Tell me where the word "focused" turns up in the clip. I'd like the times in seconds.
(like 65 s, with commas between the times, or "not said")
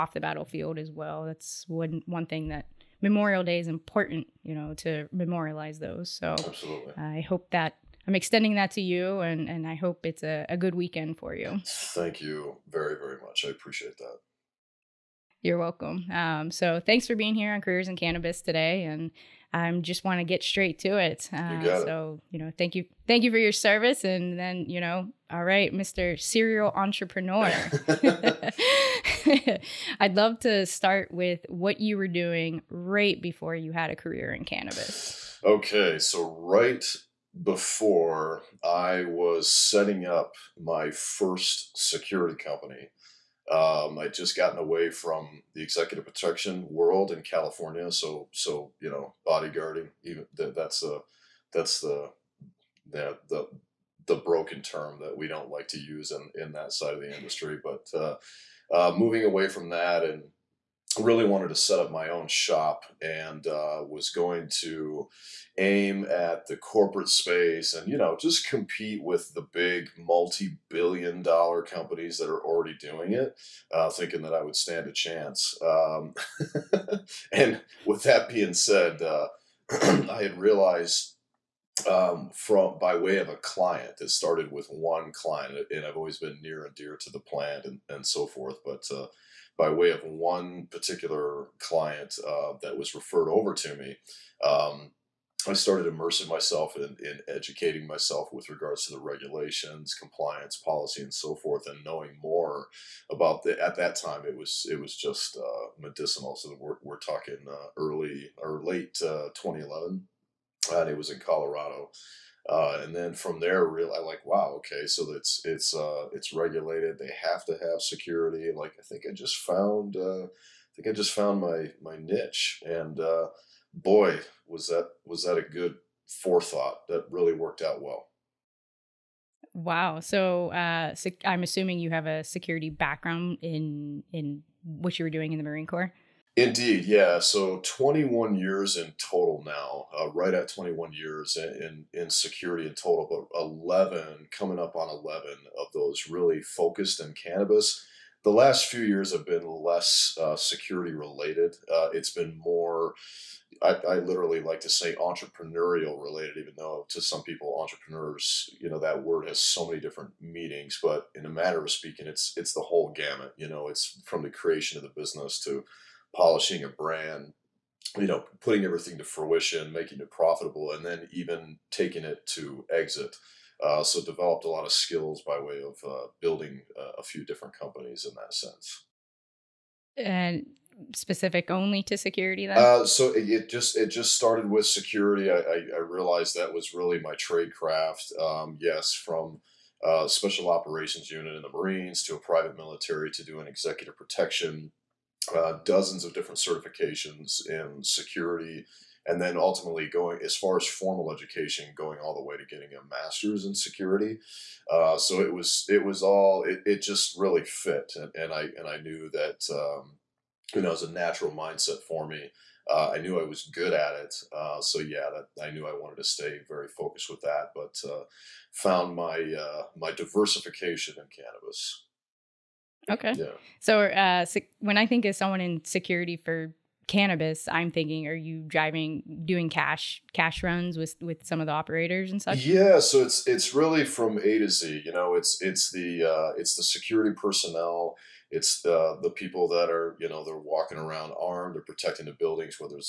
146 s, 216 s.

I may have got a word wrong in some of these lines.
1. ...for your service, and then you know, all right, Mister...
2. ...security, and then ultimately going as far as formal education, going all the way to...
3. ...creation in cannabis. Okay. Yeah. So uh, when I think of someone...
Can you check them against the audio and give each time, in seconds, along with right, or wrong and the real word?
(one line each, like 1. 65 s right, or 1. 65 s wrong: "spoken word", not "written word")
1. 23 s right
2. 197 s right
3. 219 s wrong: "diversification", not "creation".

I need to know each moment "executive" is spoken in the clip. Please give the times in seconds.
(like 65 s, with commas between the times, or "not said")
45 s, 193 s.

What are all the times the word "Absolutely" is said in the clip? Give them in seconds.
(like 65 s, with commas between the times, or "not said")
6 s.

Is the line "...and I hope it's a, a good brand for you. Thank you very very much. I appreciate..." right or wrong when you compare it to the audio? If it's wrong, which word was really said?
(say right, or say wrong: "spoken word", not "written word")
wrong: "weekend", not "brand".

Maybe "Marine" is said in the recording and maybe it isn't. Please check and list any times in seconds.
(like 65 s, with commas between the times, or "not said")
135 s, 191 s.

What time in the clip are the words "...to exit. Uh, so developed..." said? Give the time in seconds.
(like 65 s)
172 s.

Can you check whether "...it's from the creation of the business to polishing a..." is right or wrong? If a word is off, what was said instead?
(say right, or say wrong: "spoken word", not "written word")
right.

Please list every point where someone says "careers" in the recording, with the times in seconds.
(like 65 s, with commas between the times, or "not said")
17 s, 33 s.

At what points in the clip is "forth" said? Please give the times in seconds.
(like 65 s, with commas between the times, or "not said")
88 s, 101 s.